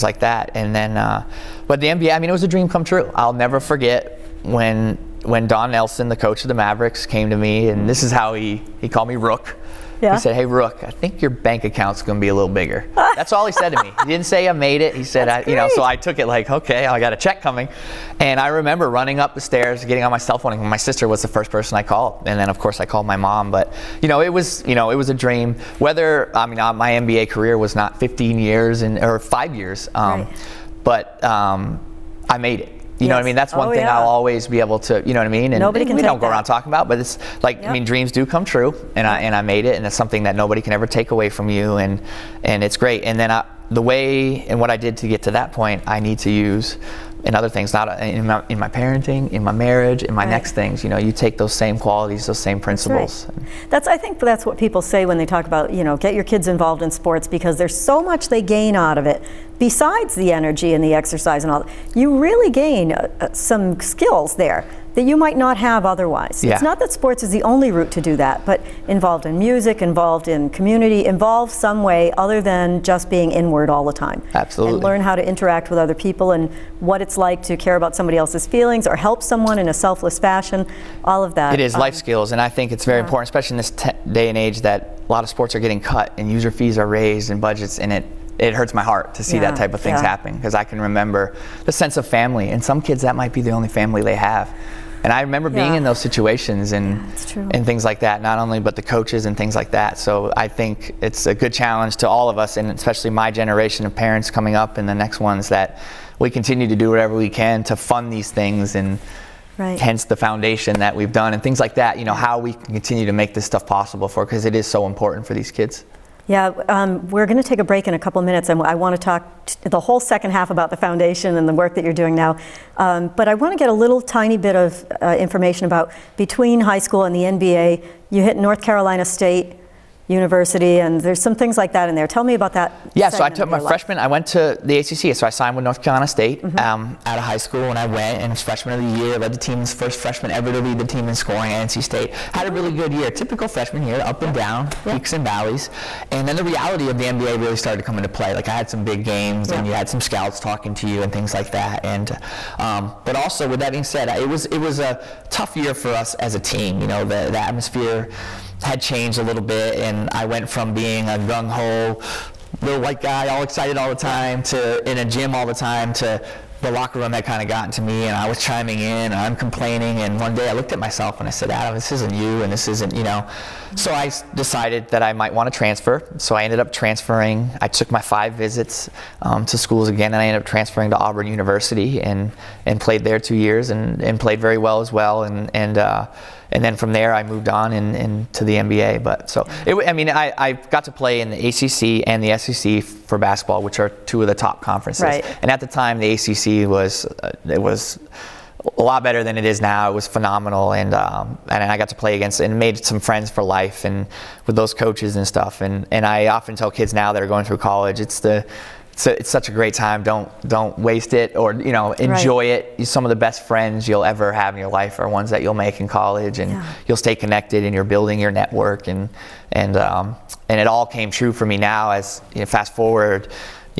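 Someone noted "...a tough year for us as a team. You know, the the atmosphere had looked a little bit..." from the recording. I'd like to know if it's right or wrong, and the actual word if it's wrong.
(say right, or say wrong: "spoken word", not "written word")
wrong: "changed", not "looked".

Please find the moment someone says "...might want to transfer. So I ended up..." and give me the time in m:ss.
2:55.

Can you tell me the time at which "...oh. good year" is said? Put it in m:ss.
2:22.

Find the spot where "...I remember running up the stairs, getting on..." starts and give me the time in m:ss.
0:18.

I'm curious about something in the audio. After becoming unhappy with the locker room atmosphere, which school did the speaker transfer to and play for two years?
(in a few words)
Auburn University.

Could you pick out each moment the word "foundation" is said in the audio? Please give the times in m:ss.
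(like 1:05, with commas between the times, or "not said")
1:50, 2:00.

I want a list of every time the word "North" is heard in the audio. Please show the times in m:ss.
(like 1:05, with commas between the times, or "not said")
2:08, 2:15.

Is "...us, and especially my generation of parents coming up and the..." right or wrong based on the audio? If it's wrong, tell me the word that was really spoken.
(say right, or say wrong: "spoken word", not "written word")
right.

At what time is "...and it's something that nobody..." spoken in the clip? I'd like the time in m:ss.
0:39.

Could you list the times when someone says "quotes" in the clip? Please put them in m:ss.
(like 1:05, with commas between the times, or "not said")
not said.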